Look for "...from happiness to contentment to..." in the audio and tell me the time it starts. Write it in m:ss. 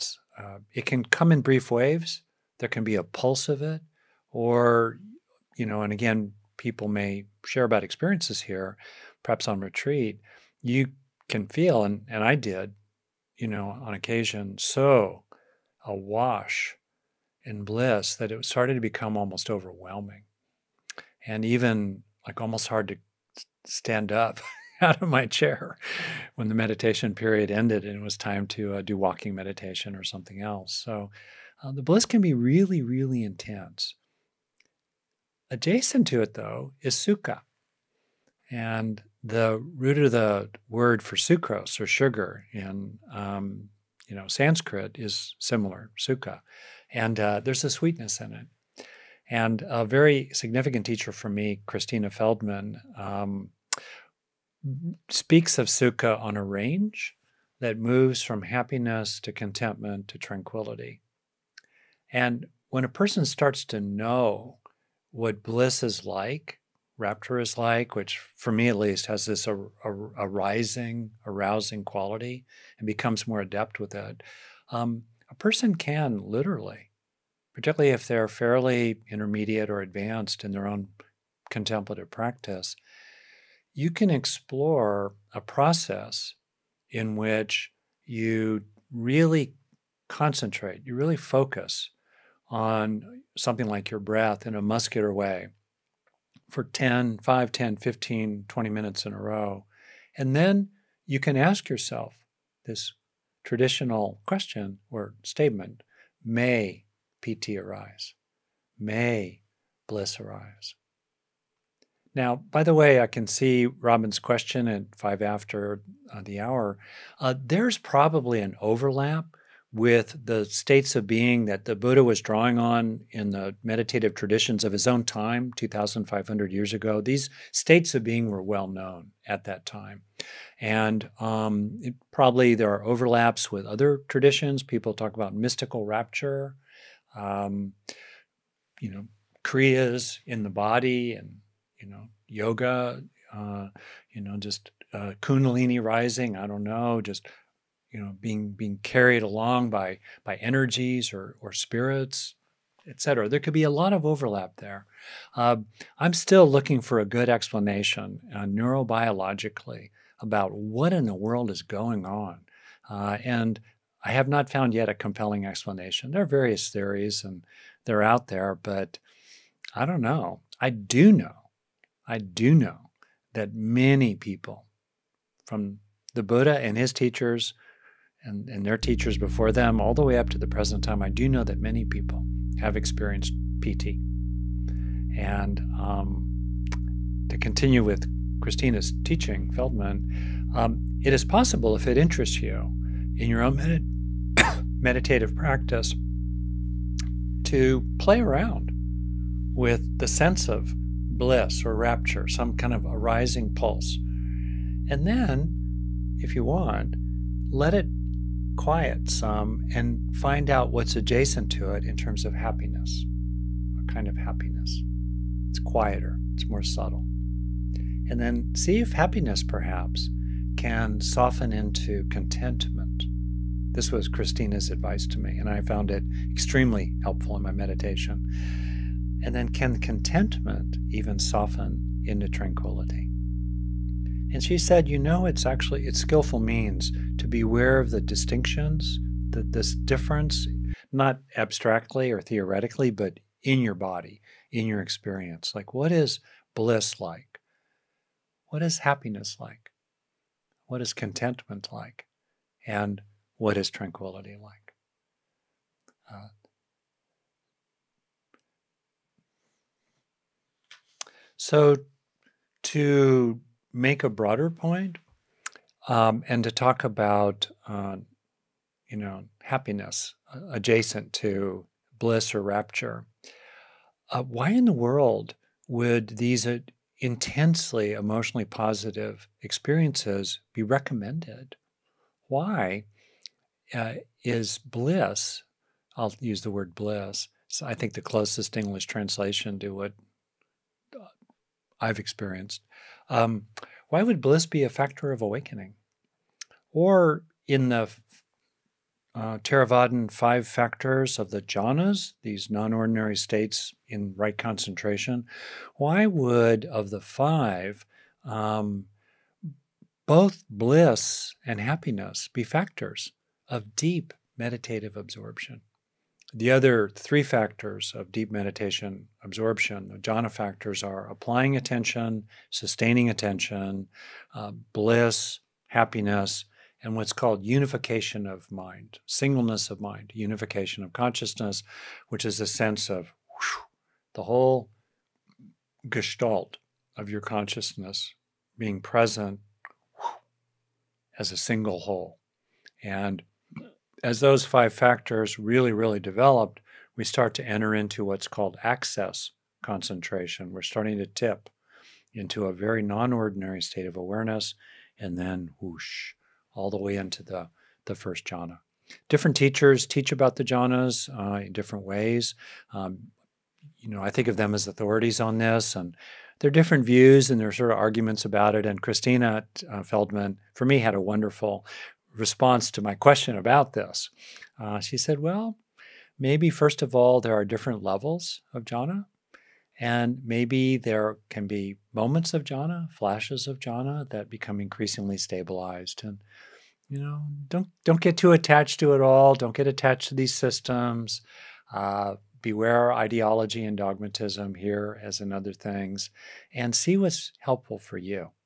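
0:58.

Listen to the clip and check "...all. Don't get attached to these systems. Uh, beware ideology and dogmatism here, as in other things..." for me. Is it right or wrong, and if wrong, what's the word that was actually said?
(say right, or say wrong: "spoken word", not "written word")
right.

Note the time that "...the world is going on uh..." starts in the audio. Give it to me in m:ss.
2:41.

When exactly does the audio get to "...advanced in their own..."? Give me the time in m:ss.
1:19.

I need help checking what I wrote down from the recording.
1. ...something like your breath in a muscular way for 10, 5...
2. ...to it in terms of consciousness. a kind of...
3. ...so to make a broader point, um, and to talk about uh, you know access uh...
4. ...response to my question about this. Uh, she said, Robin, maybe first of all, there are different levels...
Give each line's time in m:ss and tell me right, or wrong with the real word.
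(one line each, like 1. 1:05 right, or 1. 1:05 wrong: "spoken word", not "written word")
1. 1:33 right
2. 3:31 wrong: "happiness", not "consciousness"
3. 4:21 wrong: "happiness", not "access"
4. 6:12 wrong: "Well", not "Robin".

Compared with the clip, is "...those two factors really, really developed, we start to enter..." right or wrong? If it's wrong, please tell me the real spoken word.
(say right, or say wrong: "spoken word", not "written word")
wrong: "five", not "two".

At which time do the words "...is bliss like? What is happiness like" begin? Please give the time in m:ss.
4:05.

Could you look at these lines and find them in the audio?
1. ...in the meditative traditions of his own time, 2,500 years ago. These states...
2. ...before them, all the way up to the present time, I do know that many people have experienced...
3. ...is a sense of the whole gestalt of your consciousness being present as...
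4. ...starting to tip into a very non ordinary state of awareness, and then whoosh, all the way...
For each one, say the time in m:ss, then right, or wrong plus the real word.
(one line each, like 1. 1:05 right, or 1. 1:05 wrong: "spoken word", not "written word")
1. 2:03 right
2. 2:59 right
3. 5:32 right
4. 5:50 right.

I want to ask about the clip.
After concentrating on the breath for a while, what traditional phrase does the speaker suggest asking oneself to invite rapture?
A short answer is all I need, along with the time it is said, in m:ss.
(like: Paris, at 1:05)
may piti arise, at 1:46.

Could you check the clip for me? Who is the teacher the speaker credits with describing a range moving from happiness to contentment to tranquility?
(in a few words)
Christina Feldman.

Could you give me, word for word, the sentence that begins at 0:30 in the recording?
So uh, the bliss can be really, really intense.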